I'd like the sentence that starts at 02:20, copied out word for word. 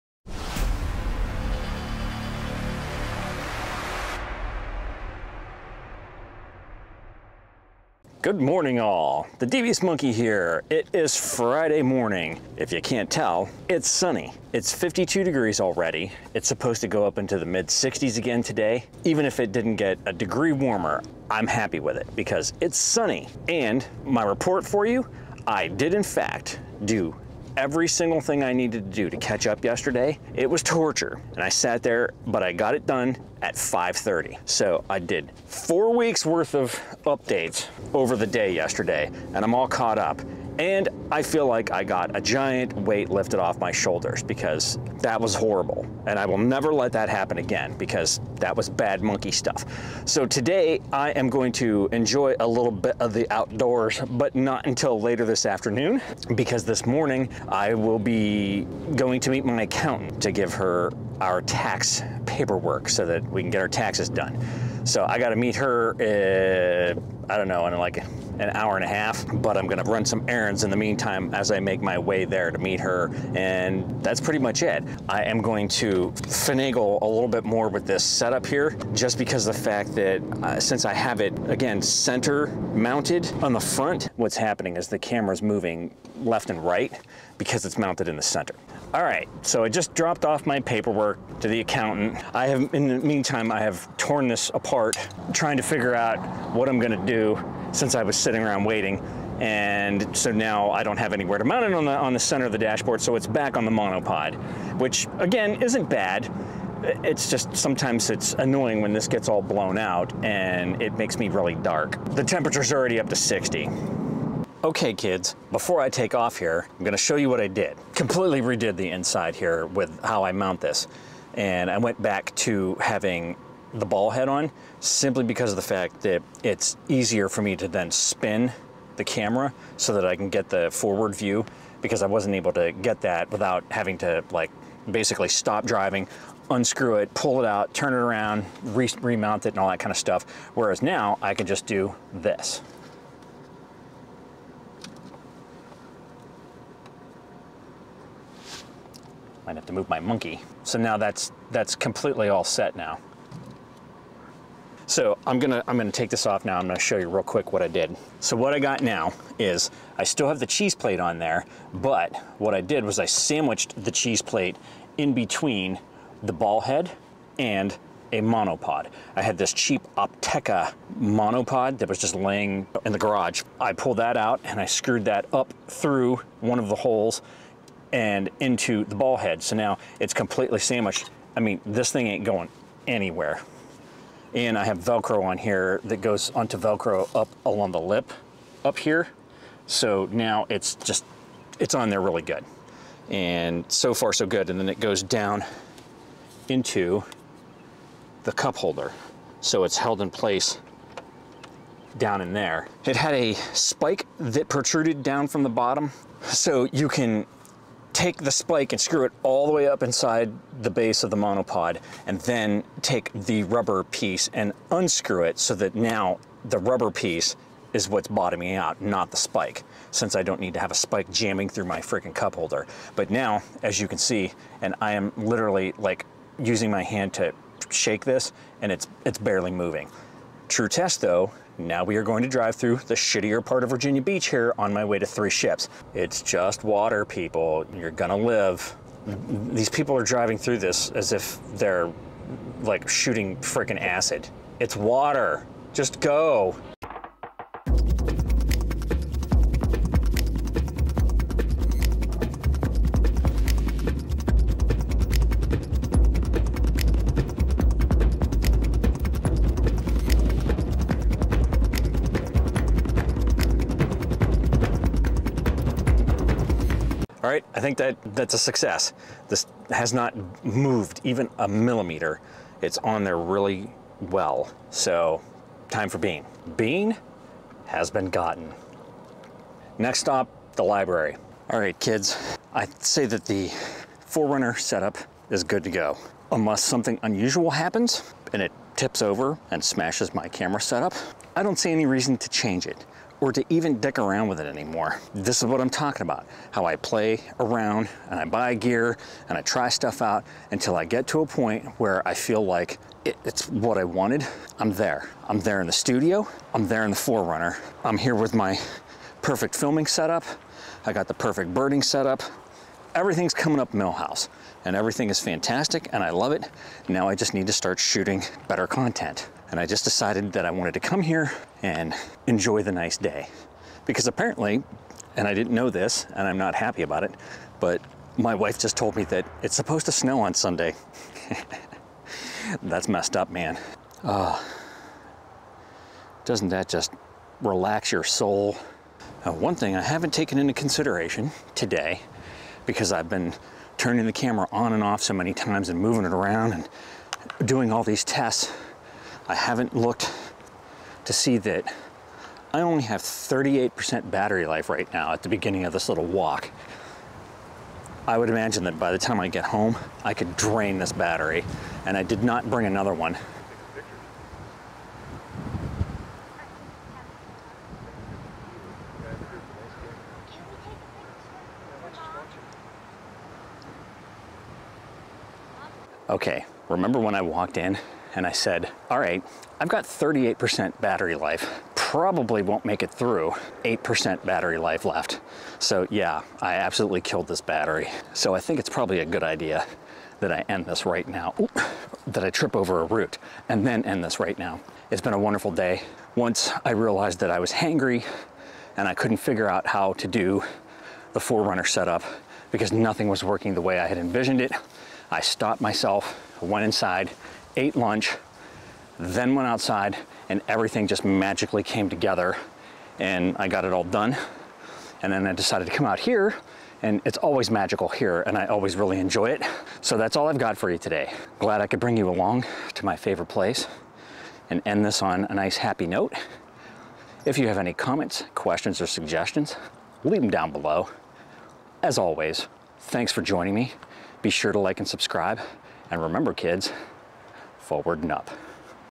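Whereas now I can just do this.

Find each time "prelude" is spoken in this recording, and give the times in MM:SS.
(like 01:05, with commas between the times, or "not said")
not said.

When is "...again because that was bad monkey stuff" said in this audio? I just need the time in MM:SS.
00:47.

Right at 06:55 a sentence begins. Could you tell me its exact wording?
And then I decided to come out here and it's always magical here and I always really enjoy it.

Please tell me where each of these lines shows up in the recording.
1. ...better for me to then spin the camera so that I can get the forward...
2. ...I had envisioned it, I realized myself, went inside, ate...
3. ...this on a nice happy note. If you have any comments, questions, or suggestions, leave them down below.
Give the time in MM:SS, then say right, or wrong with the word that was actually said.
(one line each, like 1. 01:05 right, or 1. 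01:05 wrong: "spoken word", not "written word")
1. 02:06 wrong: "easier", not "better"
2. 06:43 wrong: "stopped", not "realized"
3. 07:04 right.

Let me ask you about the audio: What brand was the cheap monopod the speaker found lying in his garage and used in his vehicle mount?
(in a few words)
Opteka.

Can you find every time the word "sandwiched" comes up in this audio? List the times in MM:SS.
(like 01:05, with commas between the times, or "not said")
02:43, 03:00.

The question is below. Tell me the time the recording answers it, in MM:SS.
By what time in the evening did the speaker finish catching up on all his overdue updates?
00:33.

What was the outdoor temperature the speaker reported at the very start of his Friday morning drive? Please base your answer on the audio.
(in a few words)
52 degrees.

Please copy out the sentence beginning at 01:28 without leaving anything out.
All right, so I just dropped off my paperwork to the accountant.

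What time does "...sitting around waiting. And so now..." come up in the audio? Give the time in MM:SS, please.
01:38.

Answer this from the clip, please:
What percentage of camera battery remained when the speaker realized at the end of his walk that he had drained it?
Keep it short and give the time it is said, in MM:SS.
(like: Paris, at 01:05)
8%, at 06:23.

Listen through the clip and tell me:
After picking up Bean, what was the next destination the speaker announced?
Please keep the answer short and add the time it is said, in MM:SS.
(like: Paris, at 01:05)
the library, at 04:40.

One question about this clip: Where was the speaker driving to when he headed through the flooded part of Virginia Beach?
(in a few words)
Three Ships.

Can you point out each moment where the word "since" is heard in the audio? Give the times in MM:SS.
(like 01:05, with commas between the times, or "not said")
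01:20, 01:37, 03:39.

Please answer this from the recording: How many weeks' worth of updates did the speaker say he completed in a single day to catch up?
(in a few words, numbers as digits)
4.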